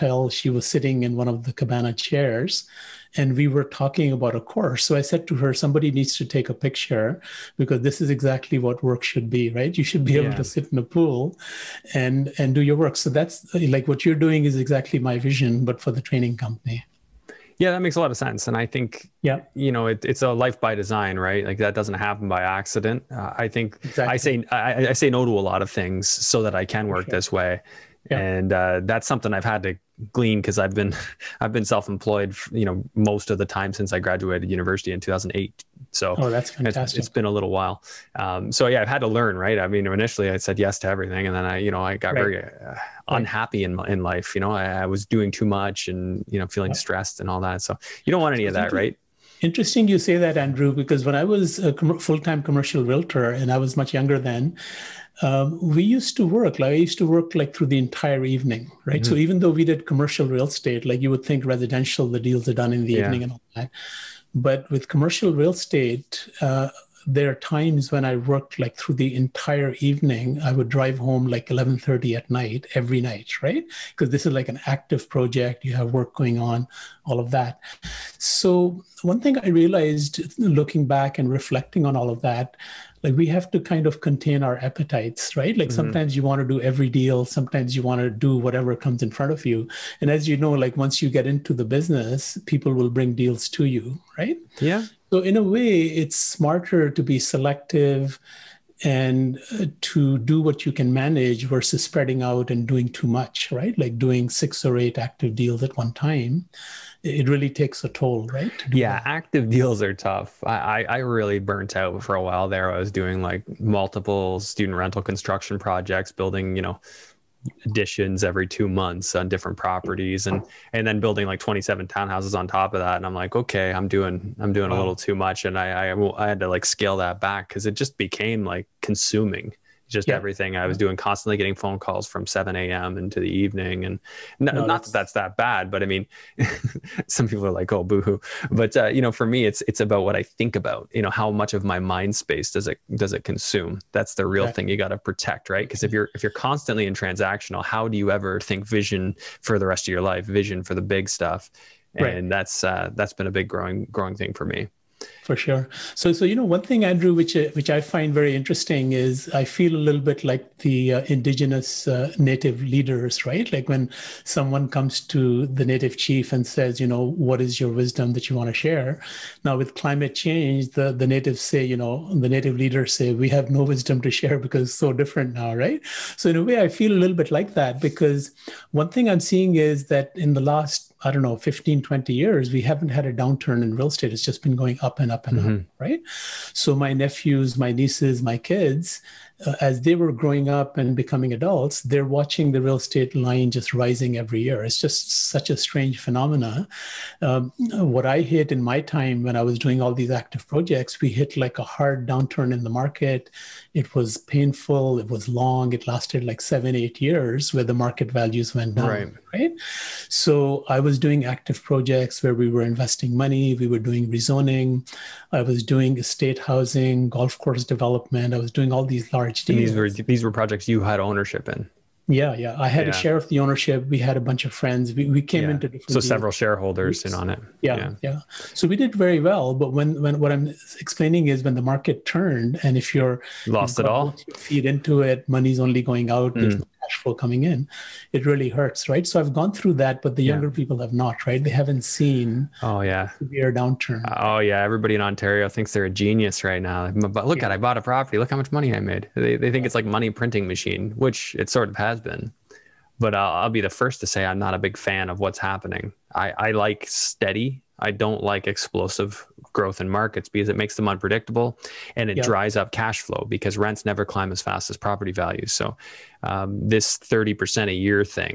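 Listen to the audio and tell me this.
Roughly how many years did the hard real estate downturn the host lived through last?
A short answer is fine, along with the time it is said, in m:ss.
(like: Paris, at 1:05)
7 or 8 years, at 3:26.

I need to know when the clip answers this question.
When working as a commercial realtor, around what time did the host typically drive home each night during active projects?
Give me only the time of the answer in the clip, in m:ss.
1:11.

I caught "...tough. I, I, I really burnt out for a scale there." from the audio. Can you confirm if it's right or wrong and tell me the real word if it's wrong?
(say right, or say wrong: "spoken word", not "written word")
wrong: "while", not "scale".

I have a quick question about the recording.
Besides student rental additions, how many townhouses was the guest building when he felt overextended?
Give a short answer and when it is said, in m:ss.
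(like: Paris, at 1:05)
27, at 2:01.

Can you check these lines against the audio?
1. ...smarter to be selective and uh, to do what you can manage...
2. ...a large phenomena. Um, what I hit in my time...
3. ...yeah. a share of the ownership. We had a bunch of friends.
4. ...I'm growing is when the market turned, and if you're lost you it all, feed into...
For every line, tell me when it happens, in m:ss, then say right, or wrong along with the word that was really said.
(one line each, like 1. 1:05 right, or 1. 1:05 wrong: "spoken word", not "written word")
1. 1:36 right
2. 3:15 wrong: "strange", not "large"
3. 3:42 right
4. 3:50 wrong: "explaining", not "growing".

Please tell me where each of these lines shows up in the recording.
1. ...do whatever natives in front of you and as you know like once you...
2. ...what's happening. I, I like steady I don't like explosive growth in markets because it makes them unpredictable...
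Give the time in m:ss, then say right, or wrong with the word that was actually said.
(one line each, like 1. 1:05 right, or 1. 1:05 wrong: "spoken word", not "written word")
1. 1:28 wrong: "comes", not "natives"
2. 4:15 right.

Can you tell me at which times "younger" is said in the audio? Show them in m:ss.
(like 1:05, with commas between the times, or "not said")
0:53, 4:00.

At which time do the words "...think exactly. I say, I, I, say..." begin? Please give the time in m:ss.
0:23.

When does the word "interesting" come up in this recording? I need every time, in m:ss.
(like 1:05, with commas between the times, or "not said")
0:49, 2:38.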